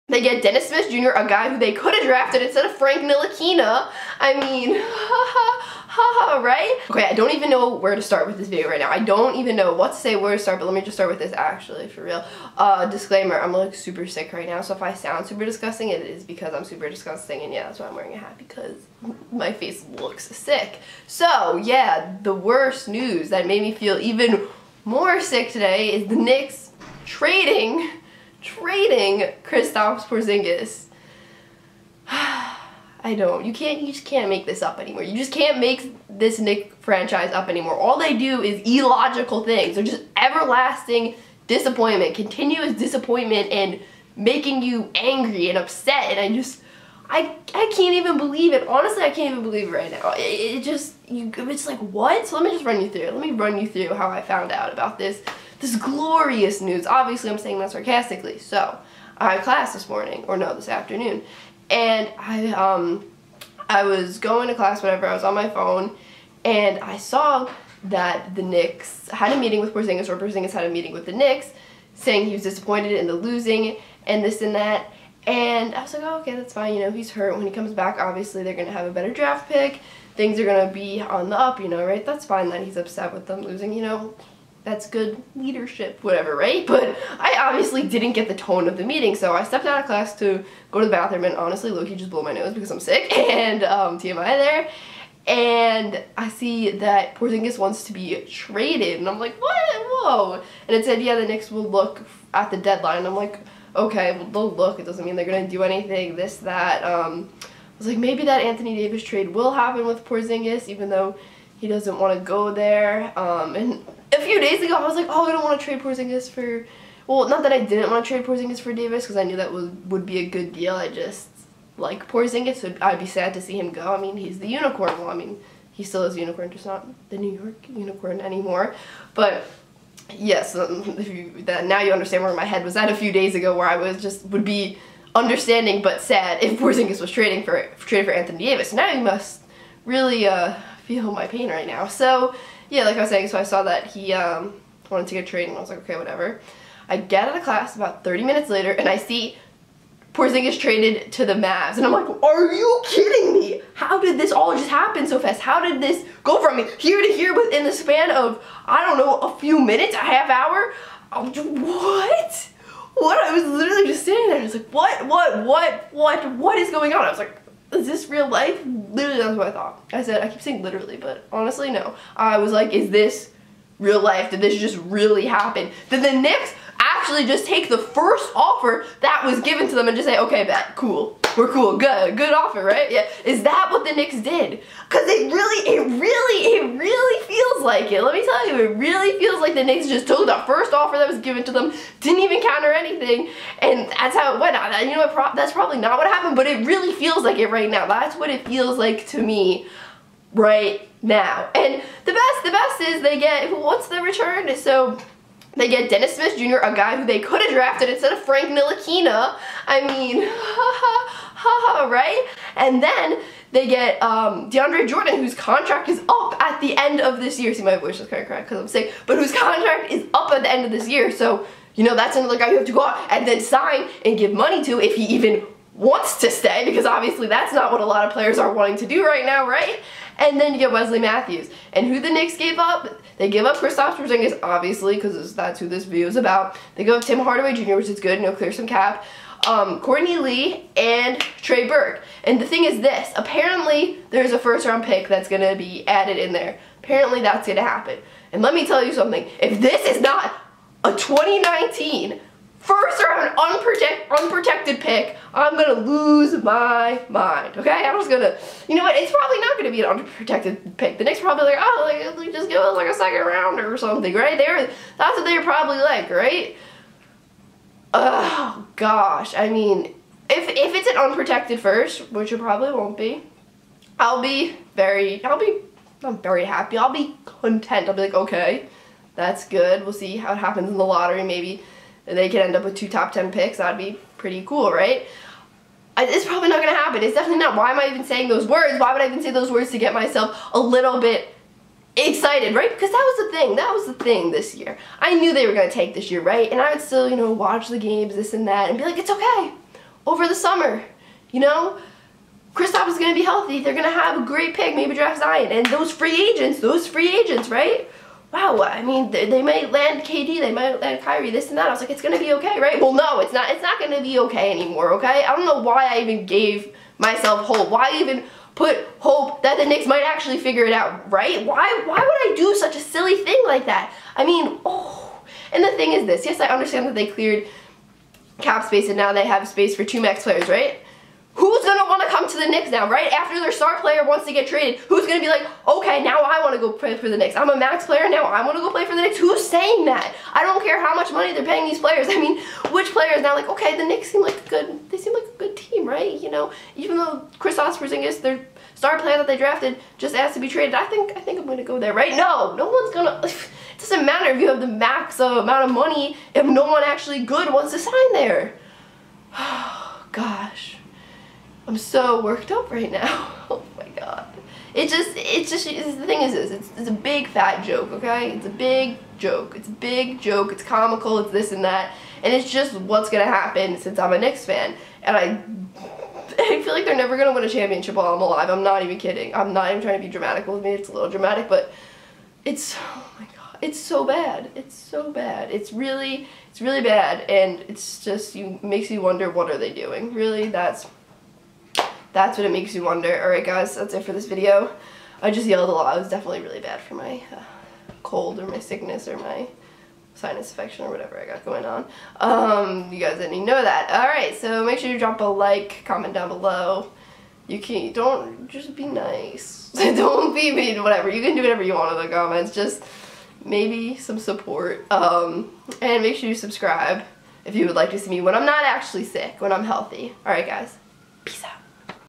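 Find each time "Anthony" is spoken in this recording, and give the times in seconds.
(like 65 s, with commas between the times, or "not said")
108 s, 138 s.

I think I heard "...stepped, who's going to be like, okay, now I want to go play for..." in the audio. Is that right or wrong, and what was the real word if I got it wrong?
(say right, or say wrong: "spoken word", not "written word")
wrong: "traded", not "stepped".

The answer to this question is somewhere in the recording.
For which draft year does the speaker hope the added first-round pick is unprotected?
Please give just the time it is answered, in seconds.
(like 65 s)
250 s.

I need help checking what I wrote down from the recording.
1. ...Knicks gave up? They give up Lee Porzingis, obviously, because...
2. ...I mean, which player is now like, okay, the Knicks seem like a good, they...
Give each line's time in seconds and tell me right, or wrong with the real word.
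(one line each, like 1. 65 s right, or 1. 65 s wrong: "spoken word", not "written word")
1. 232 s wrong: "Kristaps", not "Lee"
2. 342 s right.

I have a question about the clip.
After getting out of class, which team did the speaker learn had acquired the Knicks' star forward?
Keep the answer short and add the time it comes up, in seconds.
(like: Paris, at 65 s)
Mavs, at 151 s.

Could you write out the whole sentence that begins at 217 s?
See, my voice is kind of cracked because I'm sick, but whose contract is up at the end of this year.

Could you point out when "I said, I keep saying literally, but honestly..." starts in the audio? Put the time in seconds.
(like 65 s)
169 s.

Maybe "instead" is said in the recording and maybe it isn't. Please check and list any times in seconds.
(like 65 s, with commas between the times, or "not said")
2 s, 207 s.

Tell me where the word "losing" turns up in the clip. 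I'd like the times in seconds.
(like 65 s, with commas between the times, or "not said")
73 s, 83 s.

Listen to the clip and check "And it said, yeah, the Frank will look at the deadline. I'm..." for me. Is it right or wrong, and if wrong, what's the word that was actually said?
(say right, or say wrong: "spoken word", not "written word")
wrong: "Knicks", not "Frank".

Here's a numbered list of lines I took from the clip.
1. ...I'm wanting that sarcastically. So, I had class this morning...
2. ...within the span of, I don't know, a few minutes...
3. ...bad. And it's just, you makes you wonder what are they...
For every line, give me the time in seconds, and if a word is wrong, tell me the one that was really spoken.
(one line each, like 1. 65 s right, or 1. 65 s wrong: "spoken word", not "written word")
1. 57 s wrong: "saying", not "wanting"
2. 157 s right
3. 386 s right.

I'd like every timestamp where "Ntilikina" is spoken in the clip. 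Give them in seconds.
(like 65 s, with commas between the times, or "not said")
3 s, 208 s.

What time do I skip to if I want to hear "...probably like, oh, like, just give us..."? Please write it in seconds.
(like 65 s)
261 s.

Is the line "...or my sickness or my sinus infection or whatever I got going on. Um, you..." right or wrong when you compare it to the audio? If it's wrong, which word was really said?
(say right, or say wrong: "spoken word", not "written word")
right.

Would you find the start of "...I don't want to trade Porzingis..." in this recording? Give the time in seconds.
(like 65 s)
115 s.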